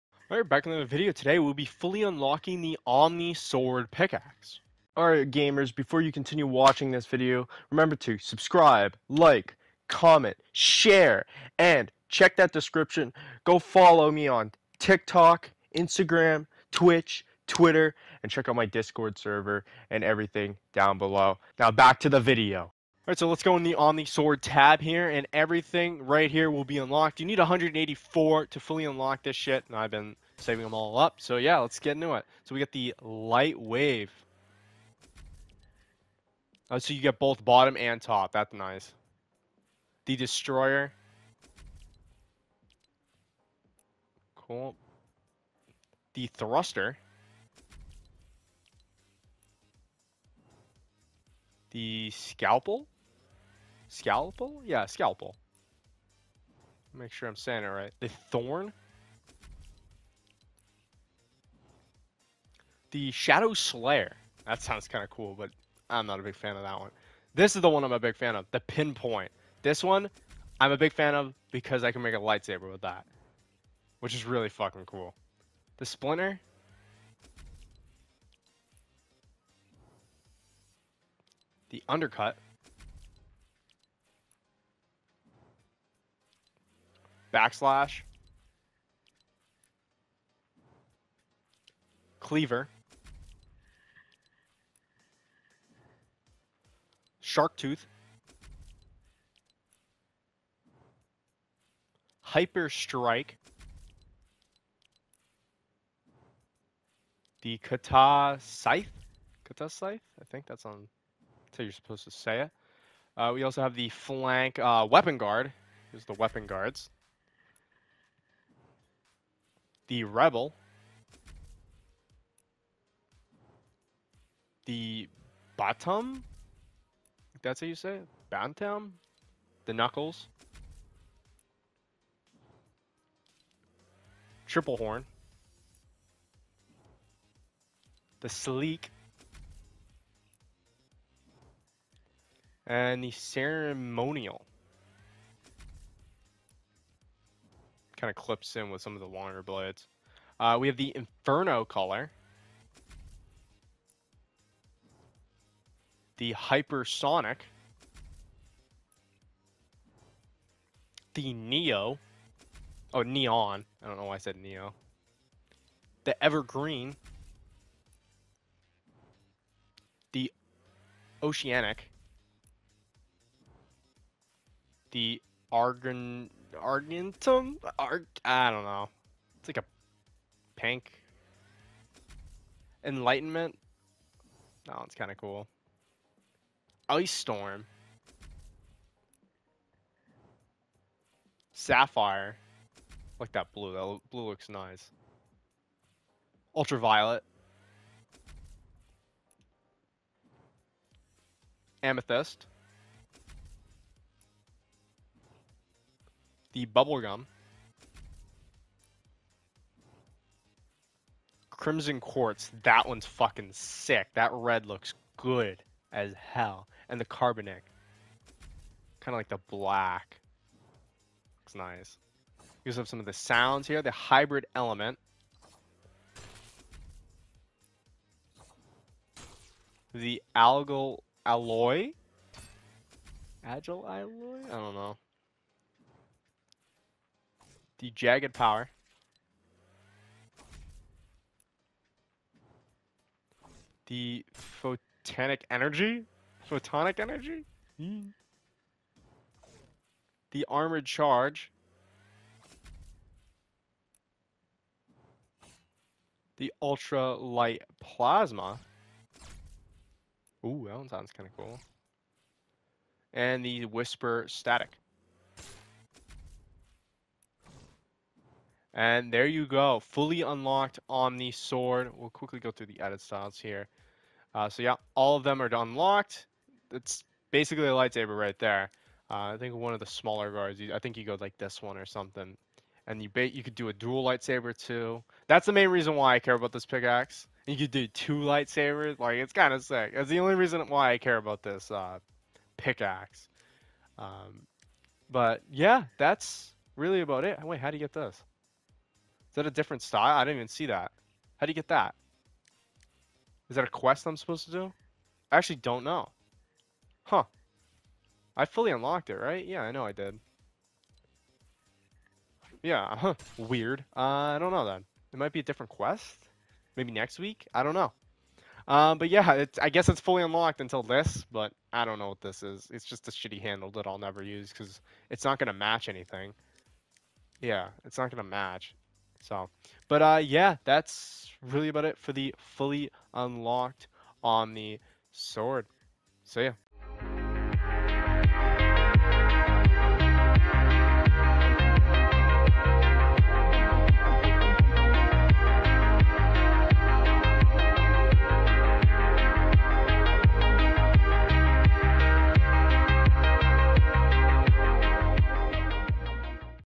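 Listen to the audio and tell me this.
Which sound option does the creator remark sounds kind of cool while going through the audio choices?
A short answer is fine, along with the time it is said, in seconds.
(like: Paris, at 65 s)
Ultra Light Plasma, at 256 s.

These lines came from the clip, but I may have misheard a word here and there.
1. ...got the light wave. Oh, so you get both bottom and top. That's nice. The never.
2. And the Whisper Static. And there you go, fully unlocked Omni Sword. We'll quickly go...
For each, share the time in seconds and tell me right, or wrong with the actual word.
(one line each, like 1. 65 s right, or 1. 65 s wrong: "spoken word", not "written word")
1. 32 s wrong: "destroyer", not "never"
2. 263 s right.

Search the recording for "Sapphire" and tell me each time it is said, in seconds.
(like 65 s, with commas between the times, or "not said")
191 s.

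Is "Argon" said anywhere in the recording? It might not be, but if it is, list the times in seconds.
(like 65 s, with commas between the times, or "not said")
175 s.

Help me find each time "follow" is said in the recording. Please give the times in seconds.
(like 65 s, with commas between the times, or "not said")
13 s.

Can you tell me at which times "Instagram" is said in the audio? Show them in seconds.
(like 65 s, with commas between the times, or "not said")
15 s.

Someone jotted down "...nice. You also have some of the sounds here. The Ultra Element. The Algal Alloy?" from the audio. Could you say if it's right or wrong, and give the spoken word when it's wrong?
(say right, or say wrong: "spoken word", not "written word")
wrong: "Hybrid", not "Ultra".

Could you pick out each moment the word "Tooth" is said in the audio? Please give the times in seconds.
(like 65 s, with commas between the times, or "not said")
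97 s.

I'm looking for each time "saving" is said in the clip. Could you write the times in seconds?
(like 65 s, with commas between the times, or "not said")
30 s.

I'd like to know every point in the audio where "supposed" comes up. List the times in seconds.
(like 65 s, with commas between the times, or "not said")
111 s, 304 s.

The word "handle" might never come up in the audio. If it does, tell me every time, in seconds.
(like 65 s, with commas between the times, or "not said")
323 s.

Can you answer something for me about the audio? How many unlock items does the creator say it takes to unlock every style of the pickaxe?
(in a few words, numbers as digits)
184.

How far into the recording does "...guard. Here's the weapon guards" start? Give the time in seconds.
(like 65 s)
115 s.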